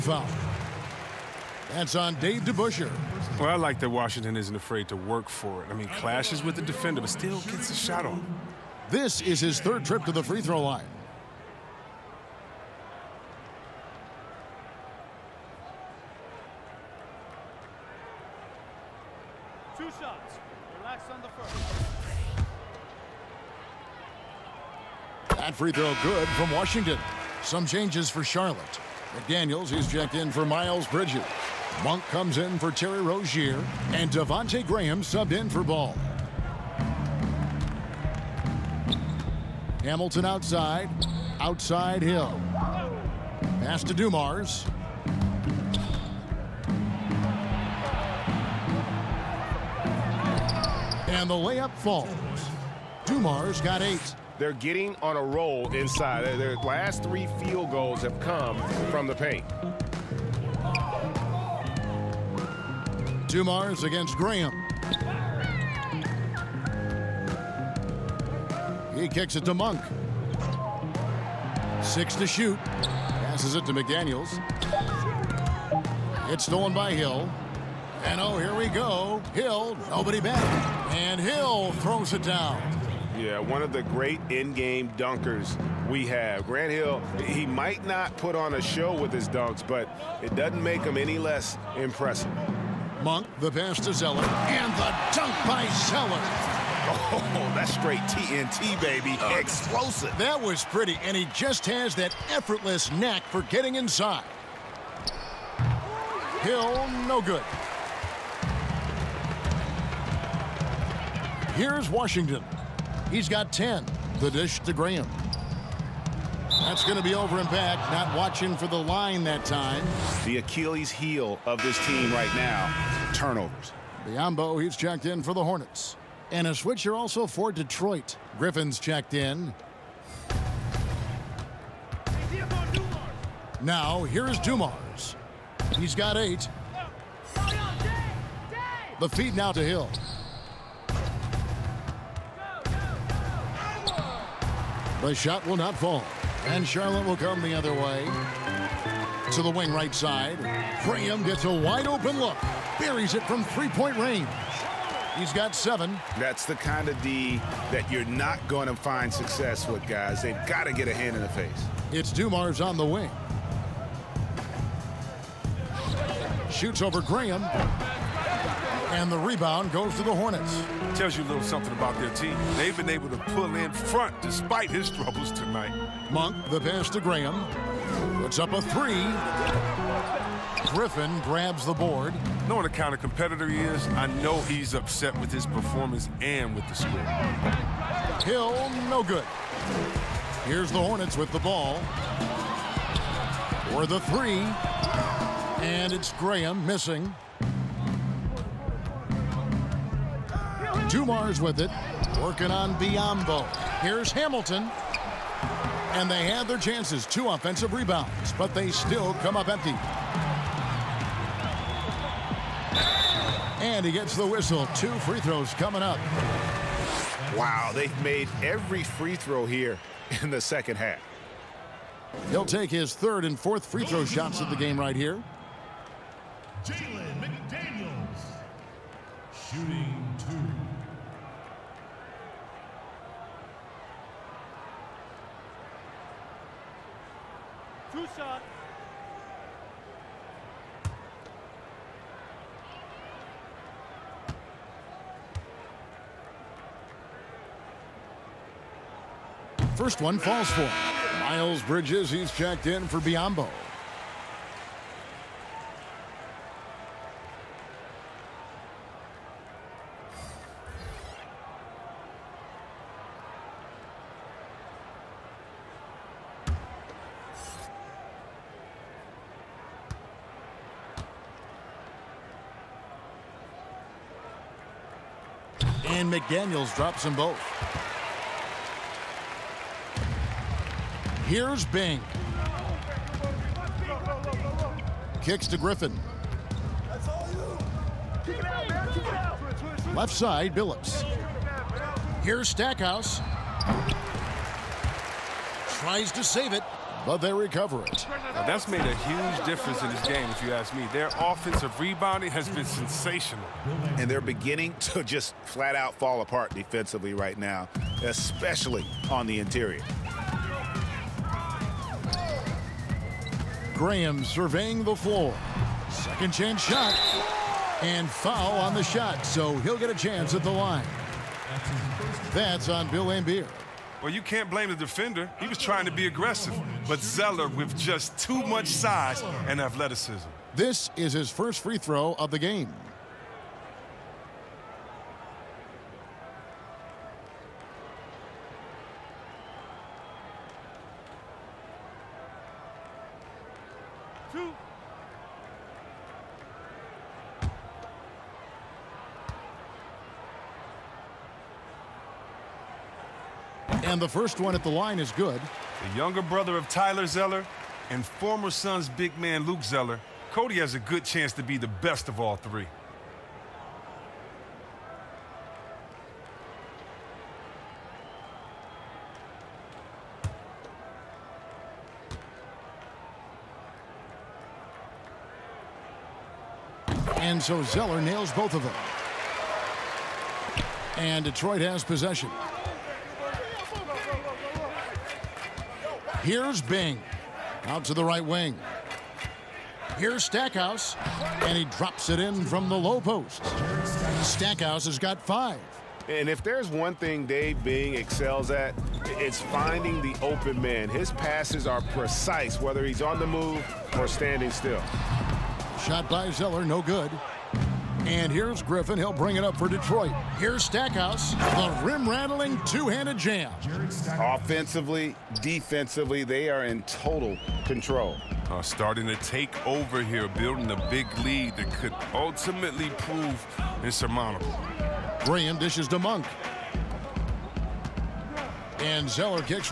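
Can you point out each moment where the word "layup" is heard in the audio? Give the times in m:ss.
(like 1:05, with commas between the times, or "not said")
0:51.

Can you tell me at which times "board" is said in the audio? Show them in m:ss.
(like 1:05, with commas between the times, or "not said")
3:01.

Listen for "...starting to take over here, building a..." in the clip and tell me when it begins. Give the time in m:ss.
6:58.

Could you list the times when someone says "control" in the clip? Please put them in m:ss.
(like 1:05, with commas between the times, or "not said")
6:57.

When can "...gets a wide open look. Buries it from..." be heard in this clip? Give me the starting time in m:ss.
2:31.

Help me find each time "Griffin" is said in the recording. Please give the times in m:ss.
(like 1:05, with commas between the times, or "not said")
2:08, 3:00, 4:45, 6:48.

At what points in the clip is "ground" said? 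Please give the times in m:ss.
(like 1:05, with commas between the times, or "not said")
not said.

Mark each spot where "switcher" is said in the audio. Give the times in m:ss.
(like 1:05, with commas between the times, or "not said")
2:06.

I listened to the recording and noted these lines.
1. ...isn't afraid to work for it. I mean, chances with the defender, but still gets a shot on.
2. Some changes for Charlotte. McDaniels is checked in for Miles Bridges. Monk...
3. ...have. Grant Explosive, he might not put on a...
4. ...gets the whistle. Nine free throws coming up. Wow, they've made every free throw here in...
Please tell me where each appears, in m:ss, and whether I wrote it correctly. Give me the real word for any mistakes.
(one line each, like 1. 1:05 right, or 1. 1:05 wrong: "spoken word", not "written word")
1. 0:04 wrong: "clashes", not "chances"
2. 0:27 right
3. 1:26 wrong: "Hill", not "Explosive"
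4. 3:33 wrong: "Two", not "Nine".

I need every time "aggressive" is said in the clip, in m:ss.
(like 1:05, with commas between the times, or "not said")
5:26.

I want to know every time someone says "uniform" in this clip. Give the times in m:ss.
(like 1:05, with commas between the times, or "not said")
not said.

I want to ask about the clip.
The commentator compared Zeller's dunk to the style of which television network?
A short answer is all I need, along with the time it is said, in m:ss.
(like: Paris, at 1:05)
TNT, at 1:38.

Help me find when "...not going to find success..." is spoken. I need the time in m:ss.
2:38.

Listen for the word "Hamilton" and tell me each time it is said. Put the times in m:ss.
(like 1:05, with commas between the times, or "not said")
0:39, 3:24.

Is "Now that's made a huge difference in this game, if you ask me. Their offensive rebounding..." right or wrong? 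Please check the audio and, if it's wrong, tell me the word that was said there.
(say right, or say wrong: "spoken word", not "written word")
right.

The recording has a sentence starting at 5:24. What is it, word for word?
Well, you can't blame the defender.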